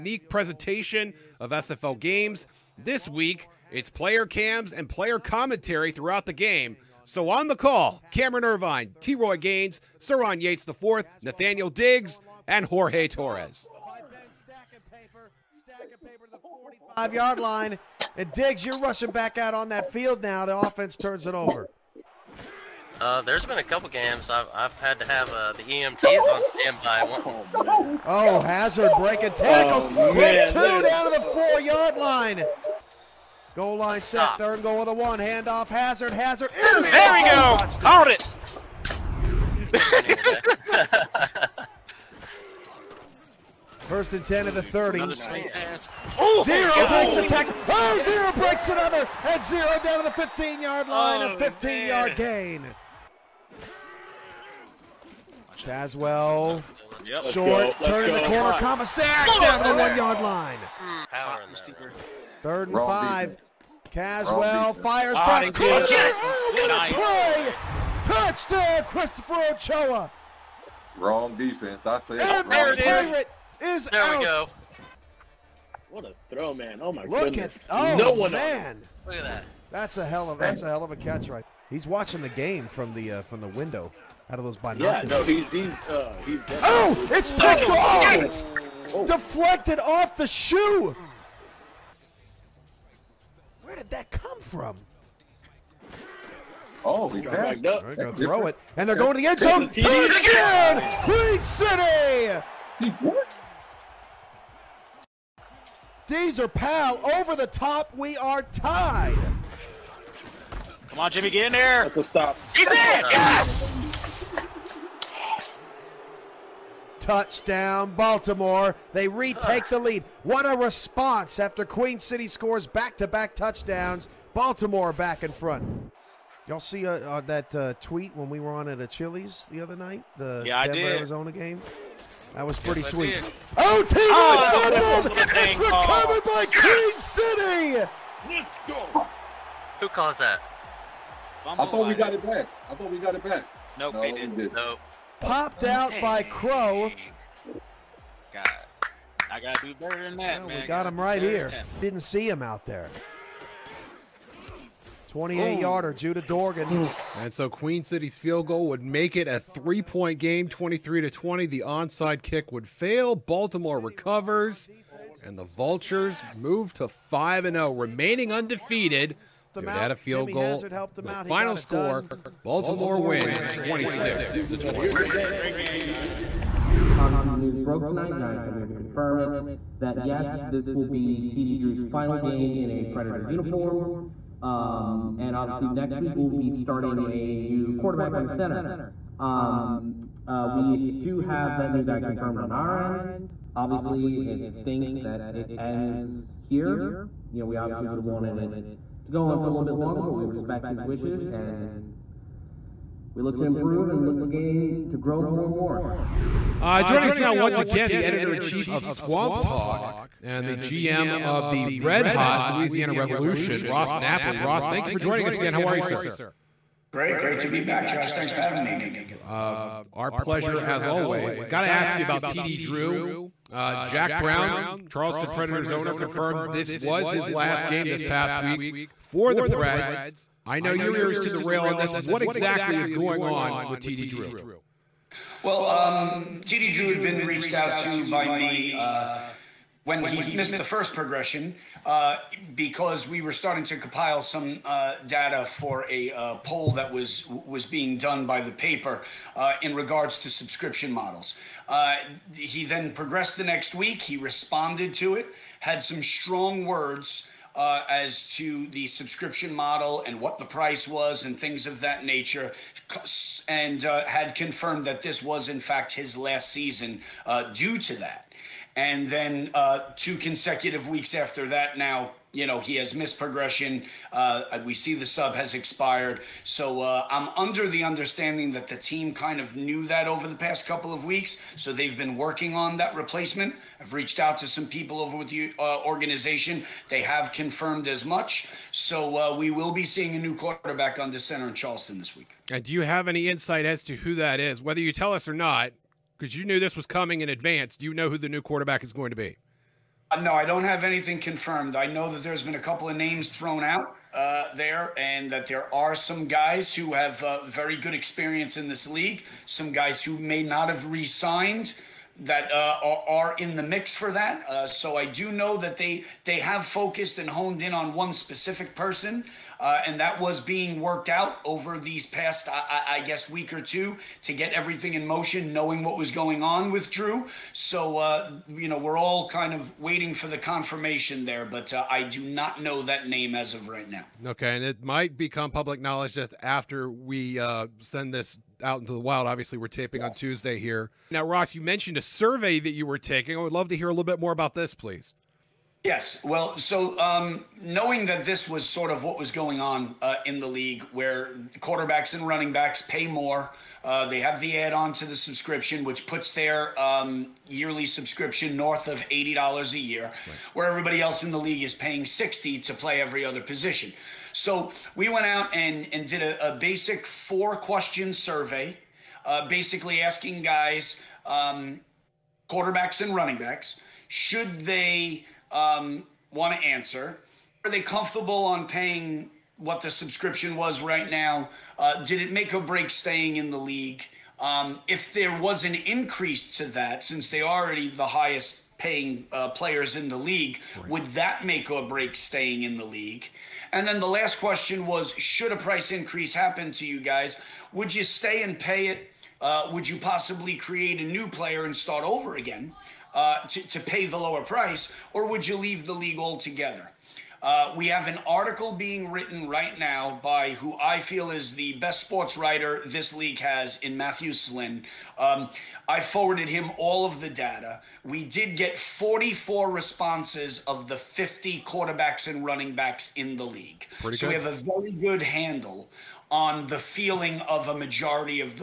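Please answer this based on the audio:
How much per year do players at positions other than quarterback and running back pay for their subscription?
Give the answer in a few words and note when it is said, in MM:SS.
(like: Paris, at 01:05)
$60, at 06:02.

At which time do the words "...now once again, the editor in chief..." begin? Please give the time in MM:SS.
03:27.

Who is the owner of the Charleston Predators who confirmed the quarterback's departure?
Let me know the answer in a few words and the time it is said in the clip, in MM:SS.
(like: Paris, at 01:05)
Jack Brown, at 03:43.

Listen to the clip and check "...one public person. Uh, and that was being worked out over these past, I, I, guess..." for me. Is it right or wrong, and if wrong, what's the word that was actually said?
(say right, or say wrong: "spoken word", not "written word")
wrong: "specific", not "public".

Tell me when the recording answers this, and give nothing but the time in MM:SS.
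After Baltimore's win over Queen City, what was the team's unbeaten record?
02:46.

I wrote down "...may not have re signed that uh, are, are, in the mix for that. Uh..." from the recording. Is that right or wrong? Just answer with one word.
right.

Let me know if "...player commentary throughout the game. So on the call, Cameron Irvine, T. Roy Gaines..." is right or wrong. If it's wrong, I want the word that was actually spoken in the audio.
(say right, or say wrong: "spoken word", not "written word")
right.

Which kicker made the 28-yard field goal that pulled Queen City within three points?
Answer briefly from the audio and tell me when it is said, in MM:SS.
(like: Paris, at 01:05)
Judah Dorgan, at 02:35.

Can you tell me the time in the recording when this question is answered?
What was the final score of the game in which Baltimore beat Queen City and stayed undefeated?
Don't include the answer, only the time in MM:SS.
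02:53.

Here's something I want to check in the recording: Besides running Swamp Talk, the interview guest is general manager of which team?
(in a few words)
Louisiana Revolution.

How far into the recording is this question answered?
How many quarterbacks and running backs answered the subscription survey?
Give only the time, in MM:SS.
06:58.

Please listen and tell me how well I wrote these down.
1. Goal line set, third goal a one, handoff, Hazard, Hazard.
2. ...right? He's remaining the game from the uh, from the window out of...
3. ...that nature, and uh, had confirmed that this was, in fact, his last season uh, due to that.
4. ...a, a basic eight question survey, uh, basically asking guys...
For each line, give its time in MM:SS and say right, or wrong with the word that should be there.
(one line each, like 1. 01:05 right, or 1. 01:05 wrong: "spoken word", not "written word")
1. 00:33 right
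2. 01:21 wrong: "watching", not "remaining"
3. 04:21 right
4. 06:06 wrong: "four", not "eight".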